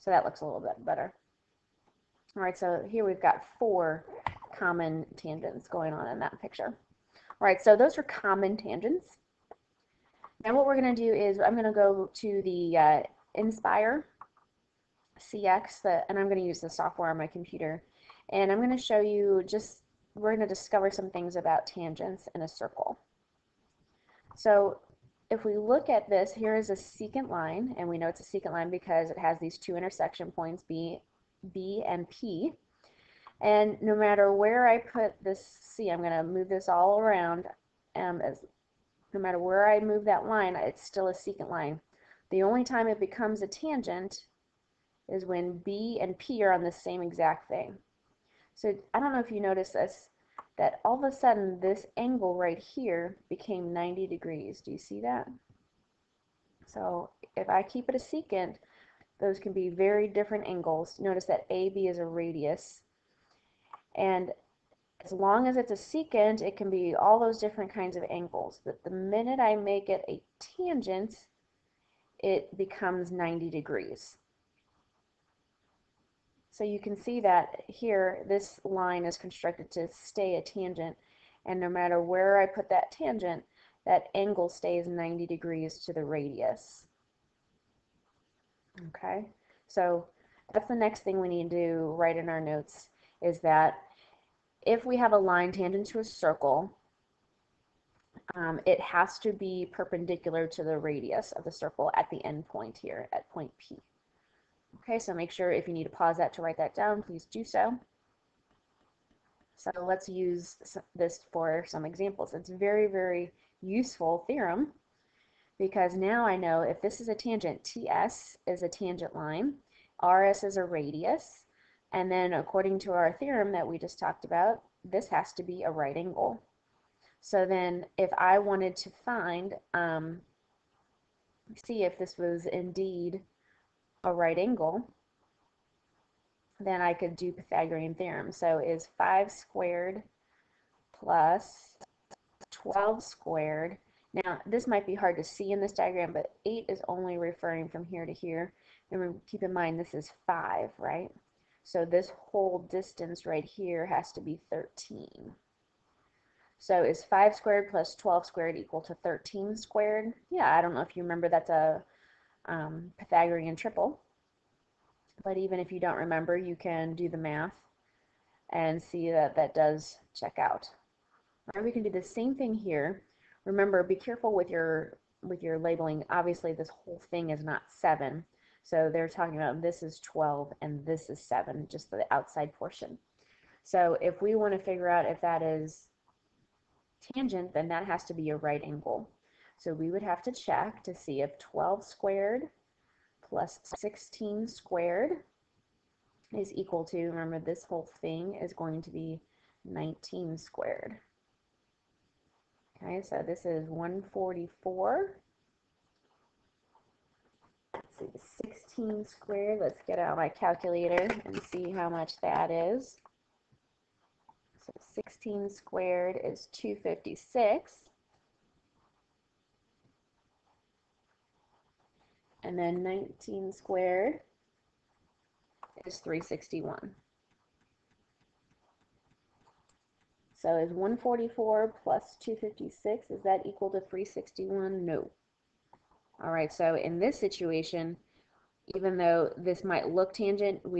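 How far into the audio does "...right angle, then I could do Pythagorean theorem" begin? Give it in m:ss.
2:14.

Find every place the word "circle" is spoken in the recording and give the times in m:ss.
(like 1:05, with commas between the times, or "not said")
0:22, 1:36, 1:41.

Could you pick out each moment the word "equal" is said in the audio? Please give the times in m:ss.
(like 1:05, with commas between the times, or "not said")
2:38, 3:16, 3:53.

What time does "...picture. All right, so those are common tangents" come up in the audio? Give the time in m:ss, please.
0:06.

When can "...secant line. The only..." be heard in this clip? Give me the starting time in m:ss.
0:41.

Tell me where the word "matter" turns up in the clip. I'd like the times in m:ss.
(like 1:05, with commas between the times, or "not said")
0:33, 0:39, 1:21.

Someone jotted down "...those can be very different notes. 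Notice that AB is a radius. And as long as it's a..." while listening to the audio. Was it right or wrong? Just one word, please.
wrong.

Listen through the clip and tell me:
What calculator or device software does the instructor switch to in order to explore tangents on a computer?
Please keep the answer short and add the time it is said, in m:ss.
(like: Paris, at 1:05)
Nspire CX, at 0:13.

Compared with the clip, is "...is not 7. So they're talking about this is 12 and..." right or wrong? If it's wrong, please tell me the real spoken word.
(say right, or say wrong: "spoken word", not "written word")
right.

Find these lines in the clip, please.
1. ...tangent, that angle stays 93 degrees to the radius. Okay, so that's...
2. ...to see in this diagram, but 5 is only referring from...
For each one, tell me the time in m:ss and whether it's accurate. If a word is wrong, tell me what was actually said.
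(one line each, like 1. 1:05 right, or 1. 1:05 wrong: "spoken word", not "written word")
1. 1:22 wrong: "90", not "93"
2. 2:25 wrong: "8", not "5".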